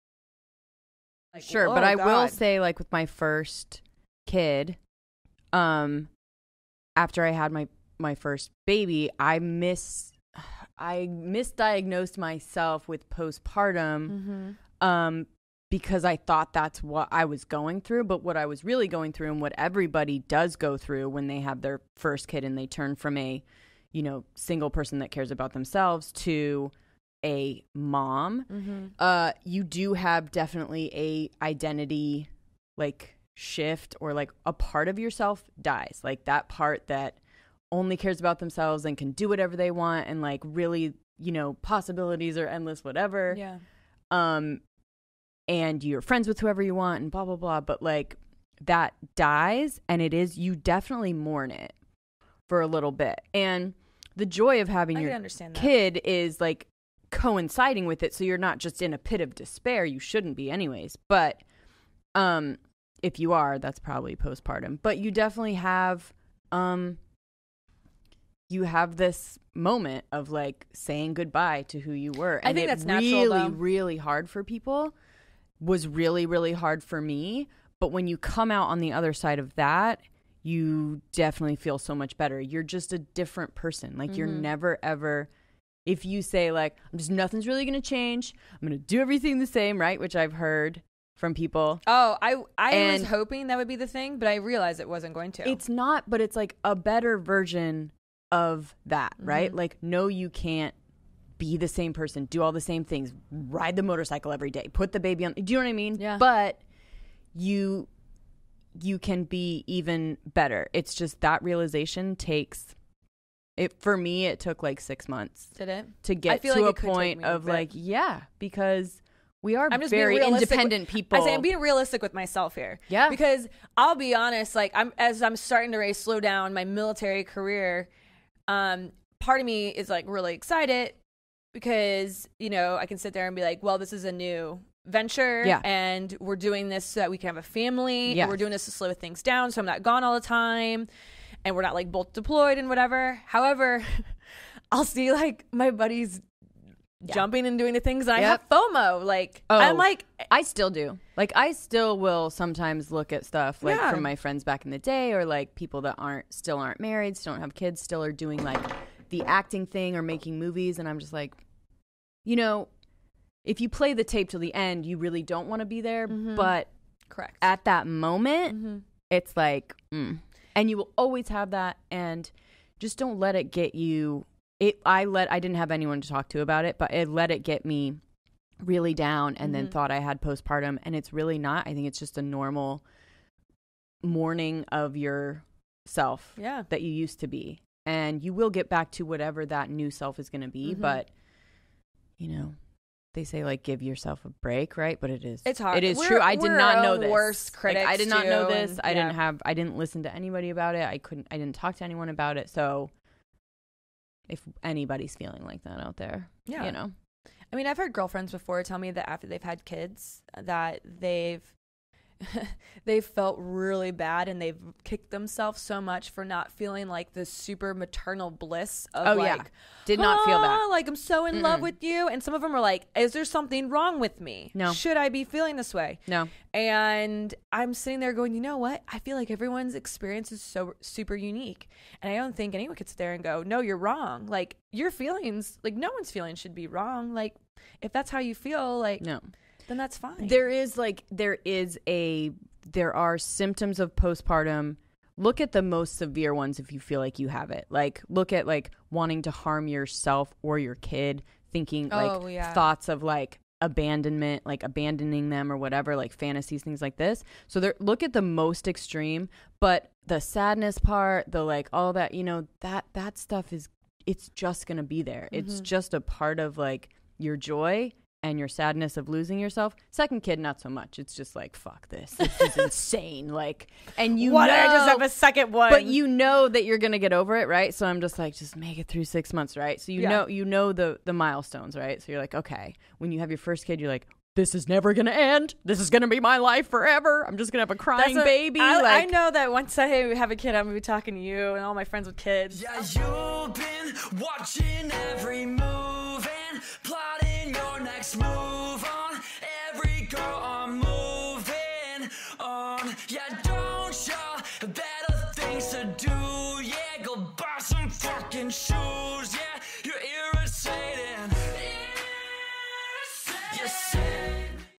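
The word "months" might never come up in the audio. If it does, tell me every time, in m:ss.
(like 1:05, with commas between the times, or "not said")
1:55, 4:39.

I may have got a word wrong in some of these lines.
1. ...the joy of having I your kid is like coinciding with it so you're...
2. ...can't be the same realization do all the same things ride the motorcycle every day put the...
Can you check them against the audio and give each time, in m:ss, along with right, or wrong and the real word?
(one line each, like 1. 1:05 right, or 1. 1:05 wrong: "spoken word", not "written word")
1. 0:54 right
2. 1:40 wrong: "person", not "realization".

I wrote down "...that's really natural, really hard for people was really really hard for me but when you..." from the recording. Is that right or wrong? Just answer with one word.
right.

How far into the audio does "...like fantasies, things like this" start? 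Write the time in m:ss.
4:15.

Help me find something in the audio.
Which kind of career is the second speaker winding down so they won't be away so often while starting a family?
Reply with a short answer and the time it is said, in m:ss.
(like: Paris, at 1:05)
military, at 2:06.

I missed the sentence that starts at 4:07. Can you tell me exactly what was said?
Like look at like wanting to harm yourself or your kid, thinking oh, like yeah.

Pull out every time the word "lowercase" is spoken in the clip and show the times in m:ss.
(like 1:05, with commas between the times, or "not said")
not said.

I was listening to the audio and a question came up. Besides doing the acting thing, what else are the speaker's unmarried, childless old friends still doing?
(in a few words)
making movies.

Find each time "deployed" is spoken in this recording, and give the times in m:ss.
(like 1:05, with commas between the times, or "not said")
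2:22.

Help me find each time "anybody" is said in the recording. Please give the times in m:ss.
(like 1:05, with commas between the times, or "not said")
3:20, 3:24.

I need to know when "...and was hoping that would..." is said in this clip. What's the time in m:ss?
1:32.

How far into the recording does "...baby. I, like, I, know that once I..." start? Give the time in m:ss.
4:48.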